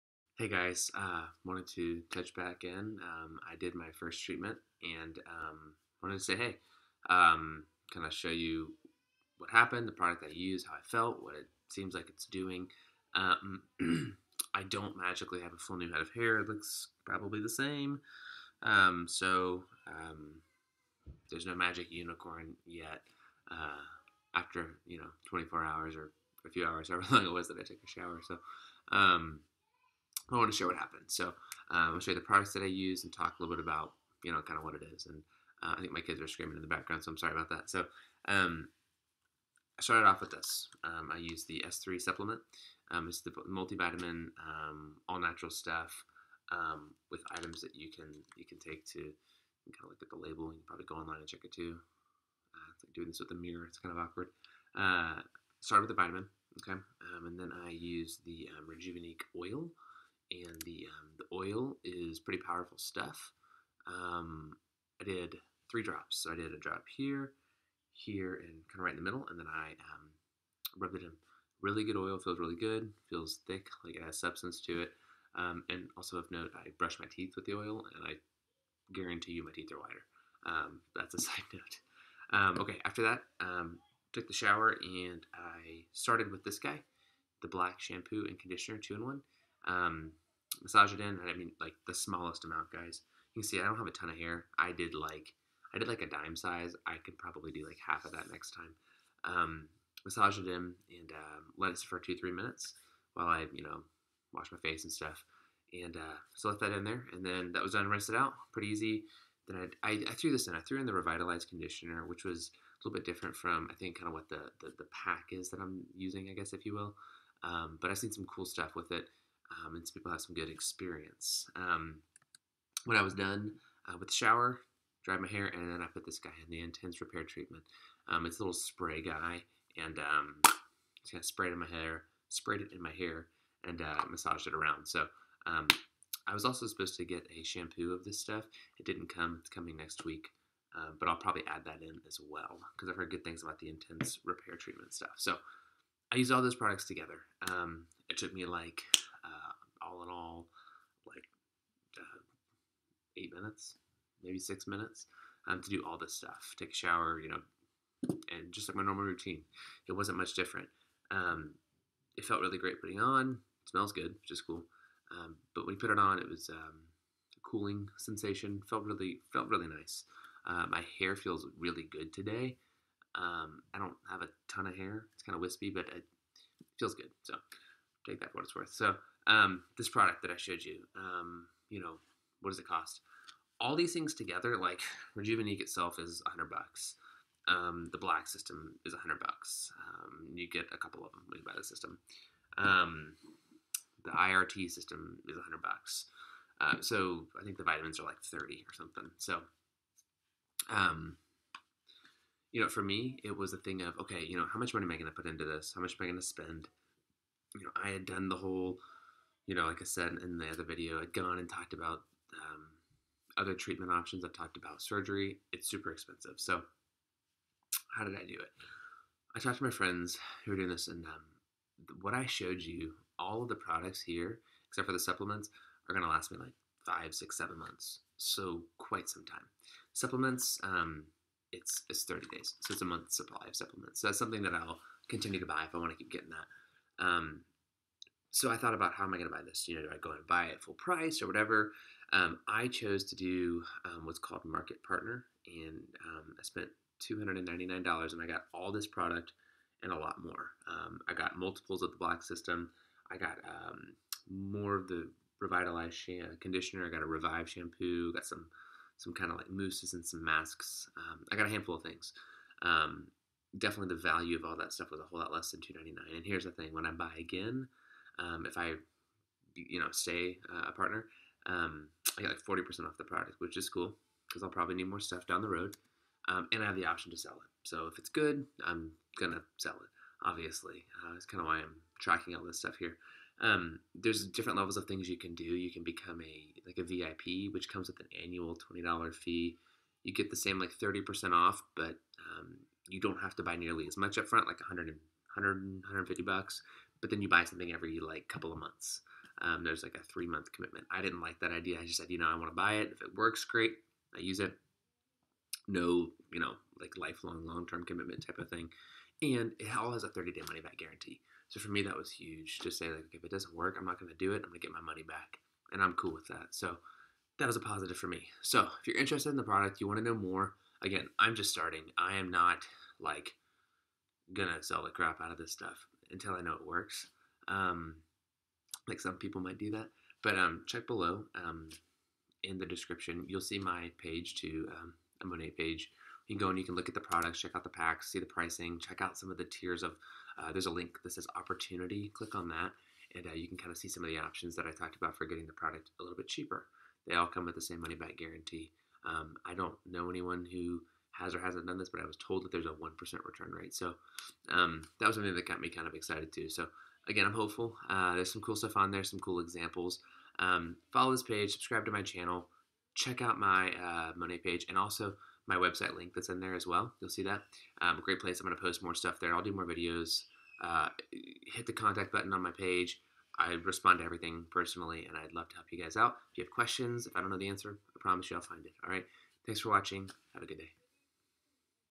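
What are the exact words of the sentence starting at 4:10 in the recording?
Um, I got multiples of the Black System.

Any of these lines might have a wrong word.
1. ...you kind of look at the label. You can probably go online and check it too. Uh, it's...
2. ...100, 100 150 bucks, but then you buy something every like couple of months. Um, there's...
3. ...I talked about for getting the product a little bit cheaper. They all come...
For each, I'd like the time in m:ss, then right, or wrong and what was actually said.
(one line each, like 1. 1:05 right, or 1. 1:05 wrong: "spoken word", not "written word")
1. 0:48 right
2. 4:54 right
3. 5:44 right.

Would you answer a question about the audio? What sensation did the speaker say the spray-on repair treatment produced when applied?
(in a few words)
cooling sensation.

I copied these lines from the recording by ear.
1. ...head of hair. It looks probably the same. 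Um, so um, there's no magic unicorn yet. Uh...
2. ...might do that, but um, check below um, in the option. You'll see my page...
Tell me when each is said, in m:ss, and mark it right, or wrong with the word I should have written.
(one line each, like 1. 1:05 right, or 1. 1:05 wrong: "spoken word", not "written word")
1. 0:15 right
2. 5:29 wrong: "description", not "option".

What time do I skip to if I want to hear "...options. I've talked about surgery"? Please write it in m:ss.
3:33.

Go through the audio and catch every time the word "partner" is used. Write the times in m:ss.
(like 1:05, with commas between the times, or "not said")
4:04, 4:30.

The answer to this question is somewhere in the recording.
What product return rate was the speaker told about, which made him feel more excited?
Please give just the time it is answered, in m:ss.
5:52.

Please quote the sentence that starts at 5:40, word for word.
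Uh, there's a link that says opportunity.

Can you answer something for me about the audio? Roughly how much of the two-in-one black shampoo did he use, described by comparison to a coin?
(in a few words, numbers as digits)
dime size.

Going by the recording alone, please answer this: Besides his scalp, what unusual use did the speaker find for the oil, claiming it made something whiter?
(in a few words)
brush my teeth.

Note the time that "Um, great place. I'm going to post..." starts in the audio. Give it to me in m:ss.
6:07.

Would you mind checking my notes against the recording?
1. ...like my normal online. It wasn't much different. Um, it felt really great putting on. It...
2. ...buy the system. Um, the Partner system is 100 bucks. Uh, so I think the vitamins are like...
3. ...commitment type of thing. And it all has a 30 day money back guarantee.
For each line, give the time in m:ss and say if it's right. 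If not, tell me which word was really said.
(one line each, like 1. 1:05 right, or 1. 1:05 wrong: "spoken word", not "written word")
1. 2:38 wrong: "routine", not "online"
2. 3:11 wrong: "IRT", not "Partner"
3. 5:07 right.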